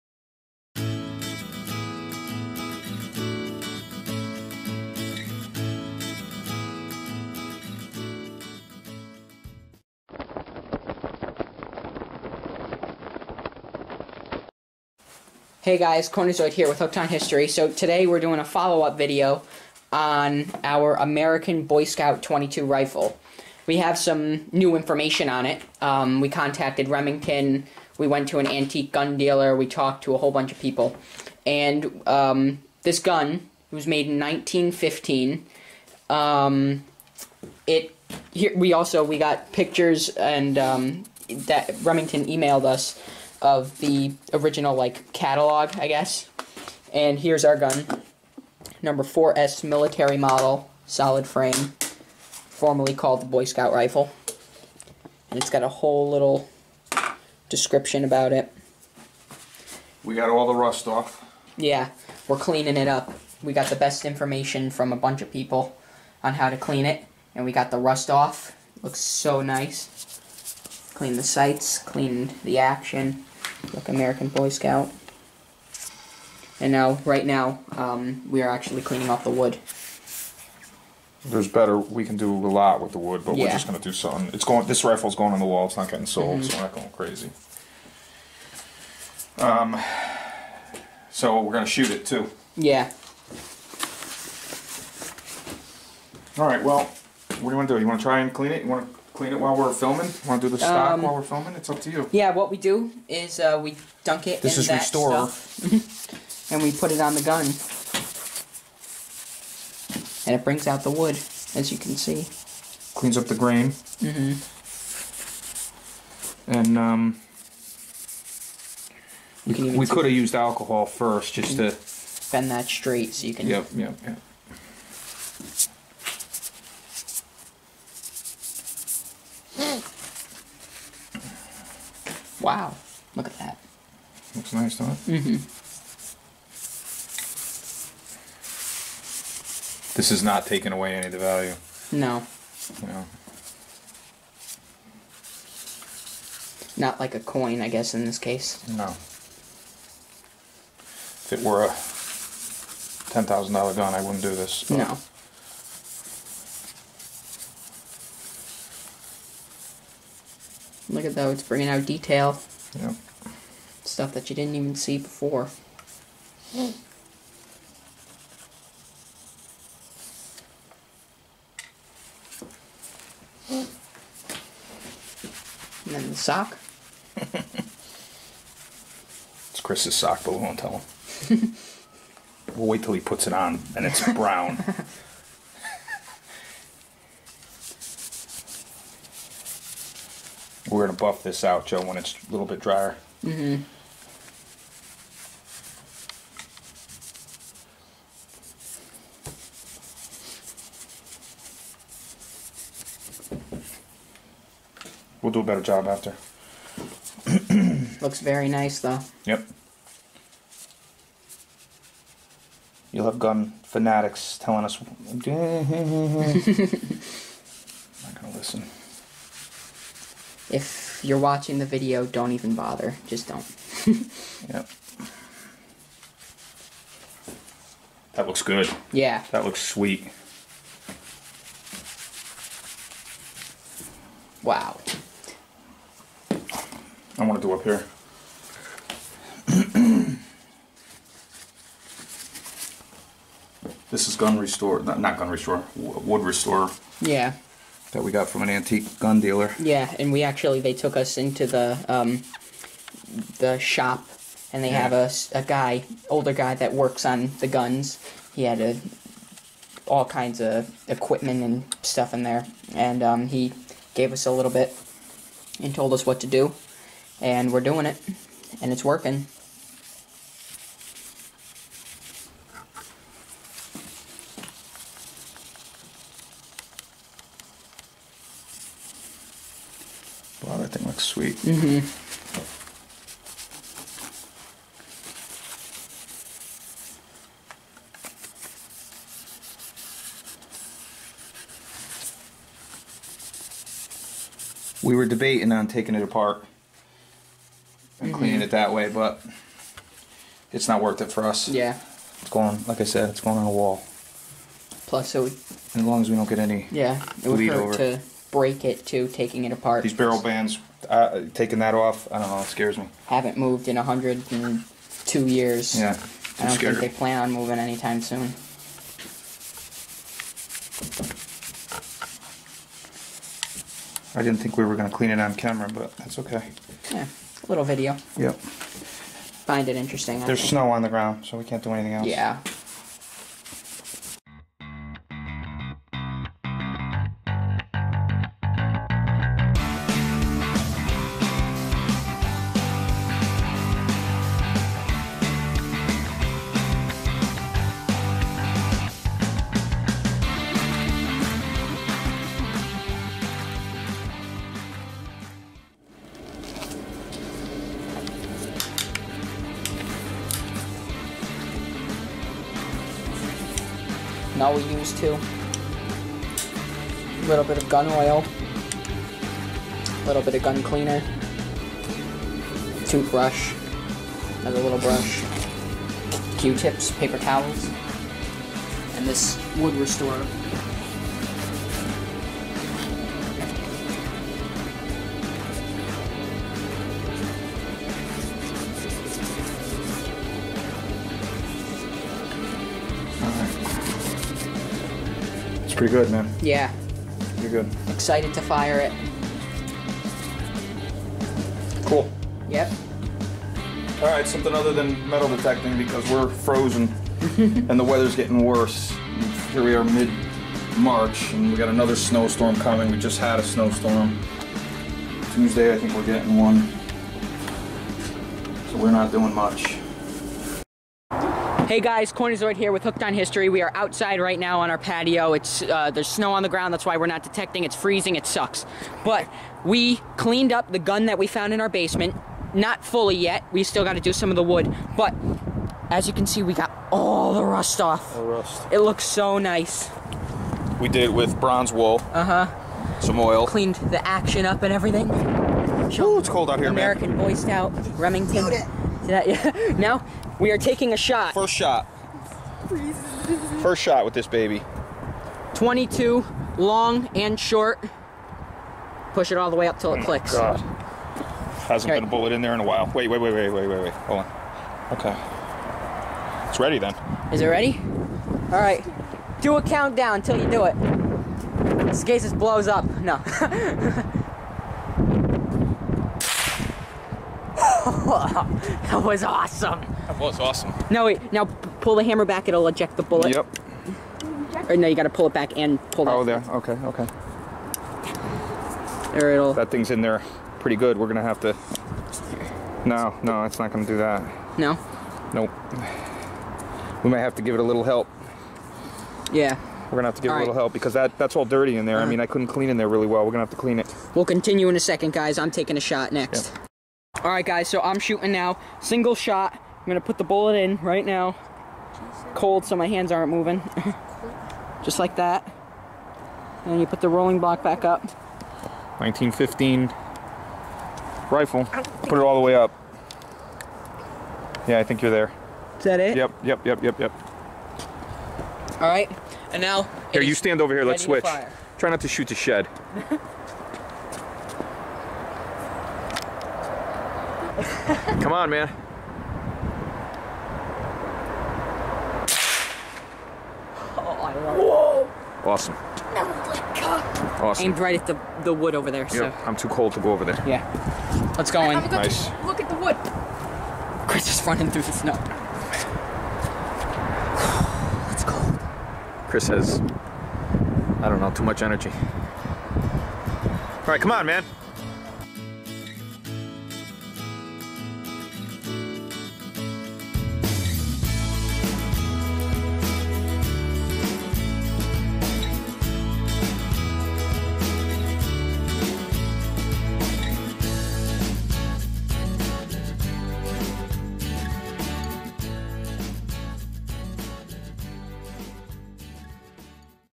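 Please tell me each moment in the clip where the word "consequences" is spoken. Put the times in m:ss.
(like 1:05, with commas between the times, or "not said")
not said.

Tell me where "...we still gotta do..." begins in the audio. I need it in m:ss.
7:13.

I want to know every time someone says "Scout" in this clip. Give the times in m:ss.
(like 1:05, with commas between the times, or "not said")
0:21, 0:53, 1:14, 7:27.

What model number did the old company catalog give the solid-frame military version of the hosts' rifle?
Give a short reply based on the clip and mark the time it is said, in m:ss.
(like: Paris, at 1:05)
4S, at 0:49.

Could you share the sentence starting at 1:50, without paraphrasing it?
And it brings out the wood, as you can see.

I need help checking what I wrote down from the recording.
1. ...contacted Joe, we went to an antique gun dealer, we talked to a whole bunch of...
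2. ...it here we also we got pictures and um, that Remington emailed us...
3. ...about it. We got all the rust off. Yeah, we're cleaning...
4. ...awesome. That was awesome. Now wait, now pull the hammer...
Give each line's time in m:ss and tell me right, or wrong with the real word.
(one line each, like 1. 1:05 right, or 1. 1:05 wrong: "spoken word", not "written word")
1. 0:26 wrong: "Remington", not "Joe"
2. 0:37 right
3. 0:58 right
4. 7:59 right.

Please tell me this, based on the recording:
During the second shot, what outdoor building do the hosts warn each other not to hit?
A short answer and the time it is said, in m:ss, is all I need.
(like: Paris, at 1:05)
The shed, at 8:52.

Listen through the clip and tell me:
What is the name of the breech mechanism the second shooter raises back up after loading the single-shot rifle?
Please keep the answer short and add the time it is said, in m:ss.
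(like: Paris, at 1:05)
Rolling block, at 8:37.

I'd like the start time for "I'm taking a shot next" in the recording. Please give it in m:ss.
8:25.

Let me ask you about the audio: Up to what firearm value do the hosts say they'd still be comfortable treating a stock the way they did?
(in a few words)
$10,000.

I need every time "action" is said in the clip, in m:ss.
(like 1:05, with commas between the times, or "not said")
1:12, 7:24.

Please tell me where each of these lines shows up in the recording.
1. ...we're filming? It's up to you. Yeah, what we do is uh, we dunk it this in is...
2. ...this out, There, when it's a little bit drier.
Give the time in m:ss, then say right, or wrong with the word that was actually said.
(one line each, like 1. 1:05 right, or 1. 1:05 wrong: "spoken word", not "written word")
1. 1:41 right
2. 3:11 wrong: "Joe", not "There".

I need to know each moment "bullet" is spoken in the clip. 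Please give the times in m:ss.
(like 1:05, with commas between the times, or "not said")
7:42, 8:03, 8:30.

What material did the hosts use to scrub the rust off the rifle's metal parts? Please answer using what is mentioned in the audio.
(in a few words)
Bronze wool.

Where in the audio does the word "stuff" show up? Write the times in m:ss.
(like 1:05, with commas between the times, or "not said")
1:45, 2:43, 4:21.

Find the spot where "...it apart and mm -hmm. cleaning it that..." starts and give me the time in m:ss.
4:55.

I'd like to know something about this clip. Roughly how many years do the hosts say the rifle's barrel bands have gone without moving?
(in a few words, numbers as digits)
102 years.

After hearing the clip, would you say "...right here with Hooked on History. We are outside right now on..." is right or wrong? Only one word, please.
right.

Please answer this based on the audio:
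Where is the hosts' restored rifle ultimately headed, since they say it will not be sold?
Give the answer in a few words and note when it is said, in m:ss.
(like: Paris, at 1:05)
On the wall, at 1:25.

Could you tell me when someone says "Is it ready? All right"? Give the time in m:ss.
7:47.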